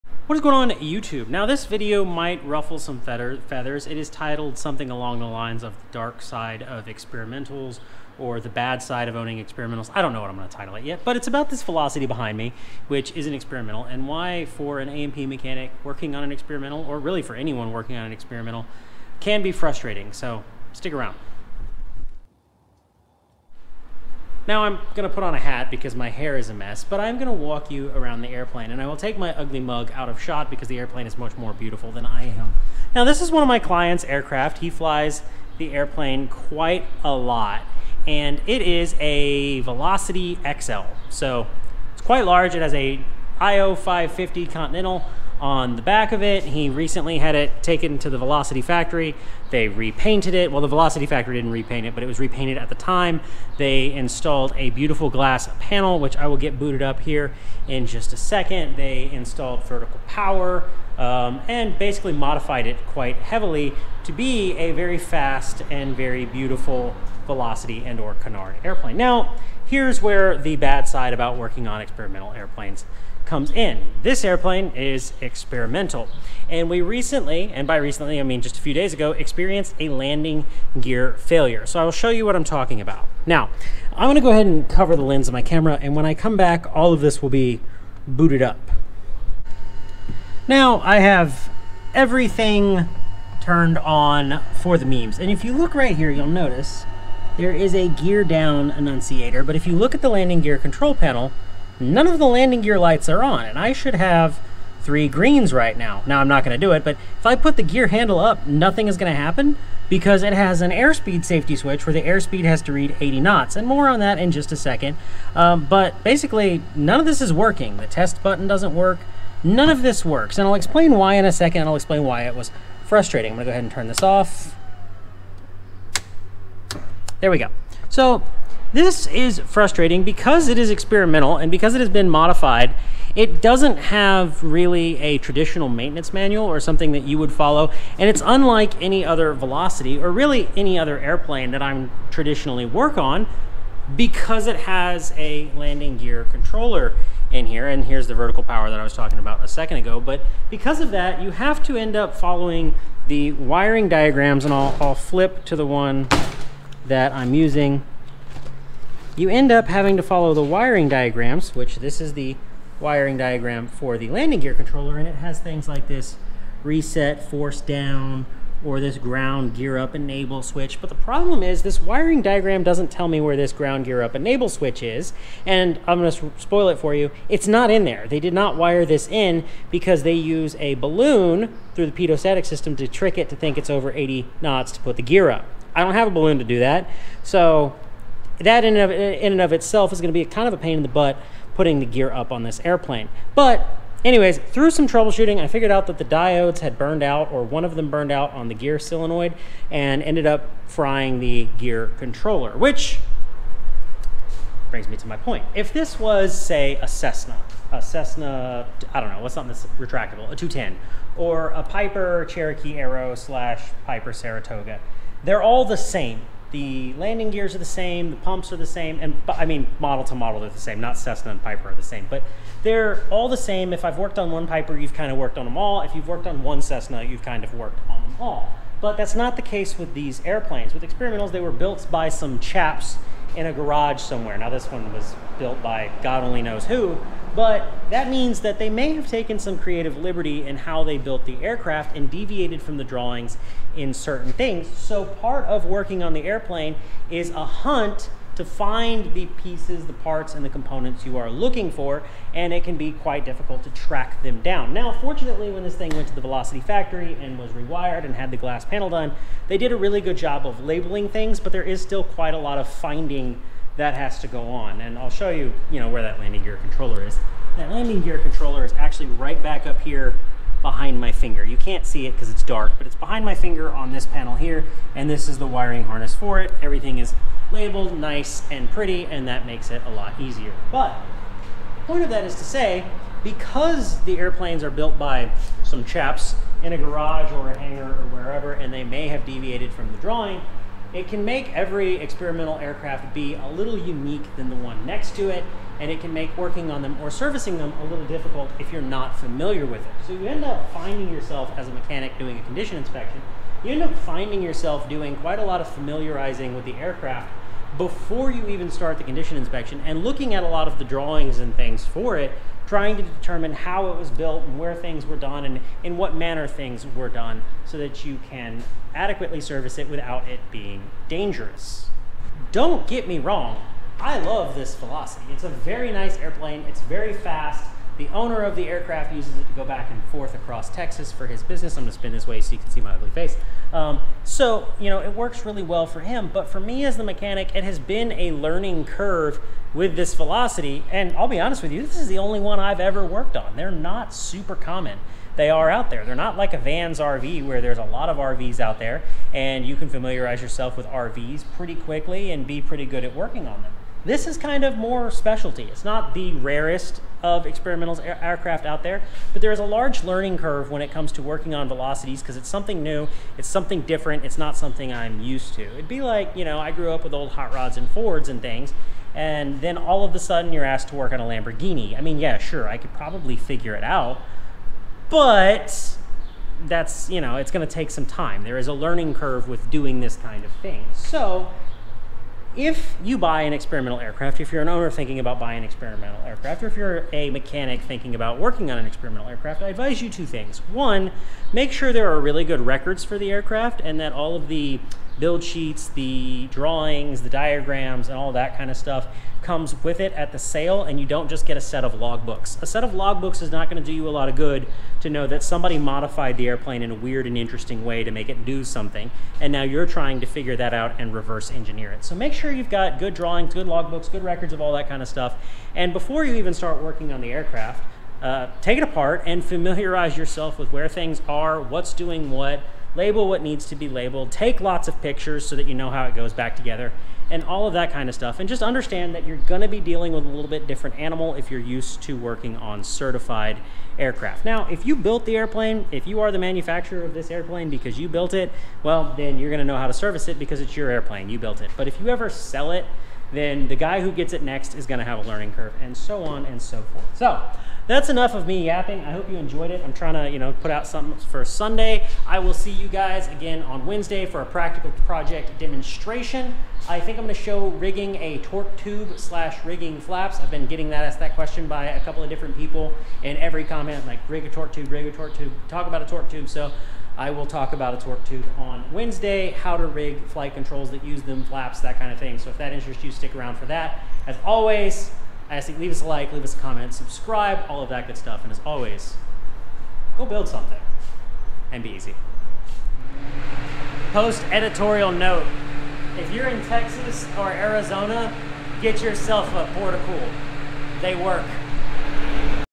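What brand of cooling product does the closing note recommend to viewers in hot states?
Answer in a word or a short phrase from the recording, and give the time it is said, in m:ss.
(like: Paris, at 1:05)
Portacool, at 8:09.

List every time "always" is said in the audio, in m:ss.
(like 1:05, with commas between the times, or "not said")
7:54, 7:58.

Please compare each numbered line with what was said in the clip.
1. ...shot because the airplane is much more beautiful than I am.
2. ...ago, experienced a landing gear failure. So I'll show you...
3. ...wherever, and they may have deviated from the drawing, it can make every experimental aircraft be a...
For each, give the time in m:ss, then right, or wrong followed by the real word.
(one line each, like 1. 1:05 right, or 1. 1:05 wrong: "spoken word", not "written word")
1. 0:30 right
2. 1:18 right
3. 4:48 right.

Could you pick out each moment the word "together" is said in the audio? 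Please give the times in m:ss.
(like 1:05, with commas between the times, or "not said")
7:06.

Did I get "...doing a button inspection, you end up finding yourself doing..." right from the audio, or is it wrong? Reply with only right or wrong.
wrong.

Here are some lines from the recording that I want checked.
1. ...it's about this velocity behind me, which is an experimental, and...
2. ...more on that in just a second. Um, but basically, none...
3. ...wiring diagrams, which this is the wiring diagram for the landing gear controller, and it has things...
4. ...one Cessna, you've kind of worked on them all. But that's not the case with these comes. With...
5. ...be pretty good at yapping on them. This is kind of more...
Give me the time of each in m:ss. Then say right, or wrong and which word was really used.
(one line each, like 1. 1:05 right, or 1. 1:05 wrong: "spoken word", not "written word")
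1. 0:11 right
2. 1:53 right
3. 2:40 right
4. 3:46 wrong: "airplanes", not "comes"
5. 5:52 wrong: "working", not "yapping".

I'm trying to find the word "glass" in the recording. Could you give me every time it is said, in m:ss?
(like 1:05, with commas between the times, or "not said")
0:55, 4:18.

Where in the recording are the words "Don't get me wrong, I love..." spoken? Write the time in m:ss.
5:22.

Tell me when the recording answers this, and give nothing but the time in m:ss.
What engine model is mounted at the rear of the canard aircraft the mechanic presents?
0:43.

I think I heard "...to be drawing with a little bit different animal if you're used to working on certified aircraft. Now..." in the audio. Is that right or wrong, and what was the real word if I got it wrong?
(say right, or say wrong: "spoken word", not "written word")
wrong: "dealing", not "drawing".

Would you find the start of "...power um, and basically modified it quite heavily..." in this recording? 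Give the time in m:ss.
1:00.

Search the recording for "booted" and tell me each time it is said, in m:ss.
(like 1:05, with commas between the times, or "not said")
0:56, 1:28.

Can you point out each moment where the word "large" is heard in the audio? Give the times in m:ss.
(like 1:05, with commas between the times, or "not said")
0:42, 5:59.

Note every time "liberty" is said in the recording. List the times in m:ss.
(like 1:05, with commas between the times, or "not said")
3:59.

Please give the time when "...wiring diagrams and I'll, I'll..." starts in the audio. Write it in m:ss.
2:33.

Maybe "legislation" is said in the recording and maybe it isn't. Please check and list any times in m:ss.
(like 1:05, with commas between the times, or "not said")
not said.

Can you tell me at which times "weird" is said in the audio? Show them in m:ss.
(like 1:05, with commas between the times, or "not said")
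6:46.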